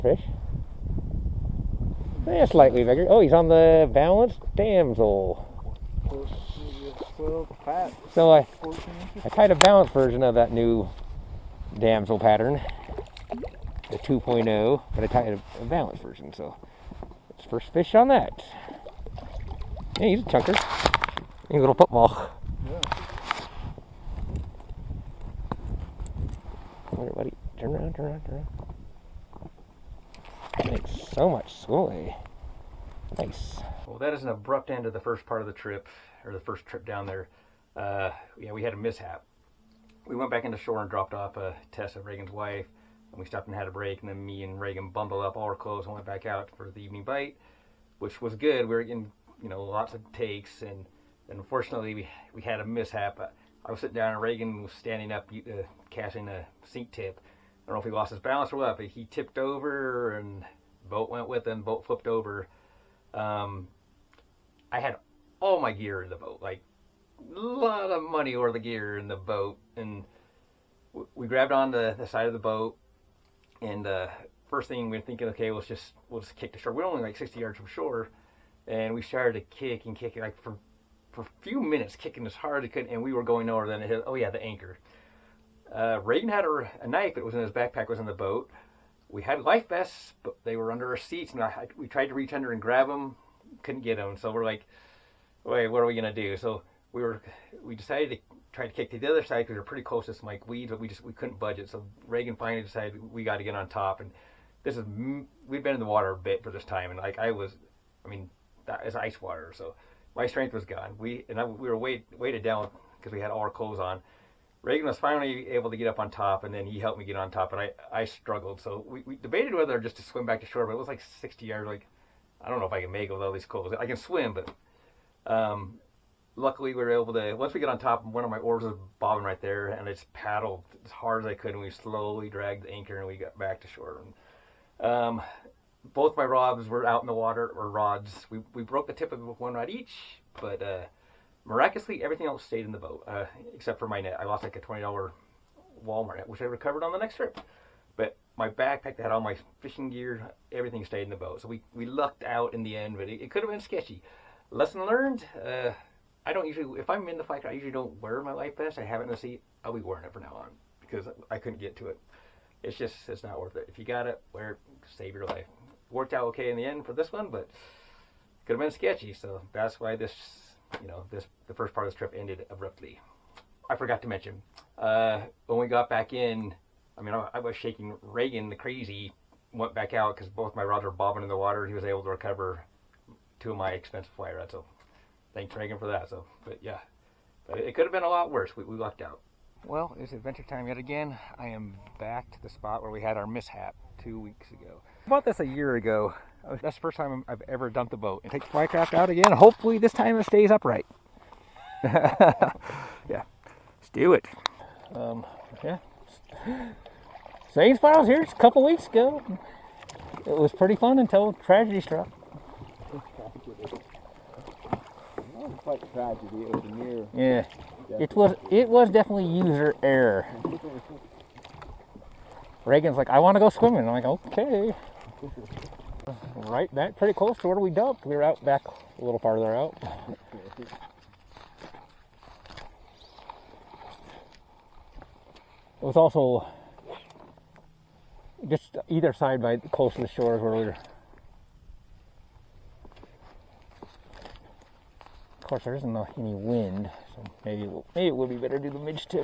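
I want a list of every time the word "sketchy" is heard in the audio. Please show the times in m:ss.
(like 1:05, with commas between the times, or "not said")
2:33, 2:48.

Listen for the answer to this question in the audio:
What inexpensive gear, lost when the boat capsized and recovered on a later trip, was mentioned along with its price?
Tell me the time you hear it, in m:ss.
2:24.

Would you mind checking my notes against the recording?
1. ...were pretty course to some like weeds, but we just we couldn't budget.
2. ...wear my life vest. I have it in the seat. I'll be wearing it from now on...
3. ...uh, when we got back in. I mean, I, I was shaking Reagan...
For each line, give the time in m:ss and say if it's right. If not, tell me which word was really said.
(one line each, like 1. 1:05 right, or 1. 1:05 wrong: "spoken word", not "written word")
1. 1:39 wrong: "close", not "course"
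2. 2:38 right
3. 2:54 right.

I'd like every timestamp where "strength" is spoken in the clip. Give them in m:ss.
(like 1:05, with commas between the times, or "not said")
1:50.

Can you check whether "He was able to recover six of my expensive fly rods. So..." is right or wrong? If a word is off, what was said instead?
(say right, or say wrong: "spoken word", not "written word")
wrong: "two", not "six".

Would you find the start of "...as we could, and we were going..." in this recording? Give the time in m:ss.
1:22.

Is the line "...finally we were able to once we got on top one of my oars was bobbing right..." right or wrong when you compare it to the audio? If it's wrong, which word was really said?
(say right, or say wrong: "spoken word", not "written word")
wrong: "luckily", not "finally".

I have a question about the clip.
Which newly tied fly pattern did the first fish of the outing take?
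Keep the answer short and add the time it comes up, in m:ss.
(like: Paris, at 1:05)
Balanced damsel, at 0:03.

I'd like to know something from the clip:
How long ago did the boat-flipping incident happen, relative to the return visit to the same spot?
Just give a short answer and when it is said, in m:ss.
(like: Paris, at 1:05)
Two weeks, at 3:14.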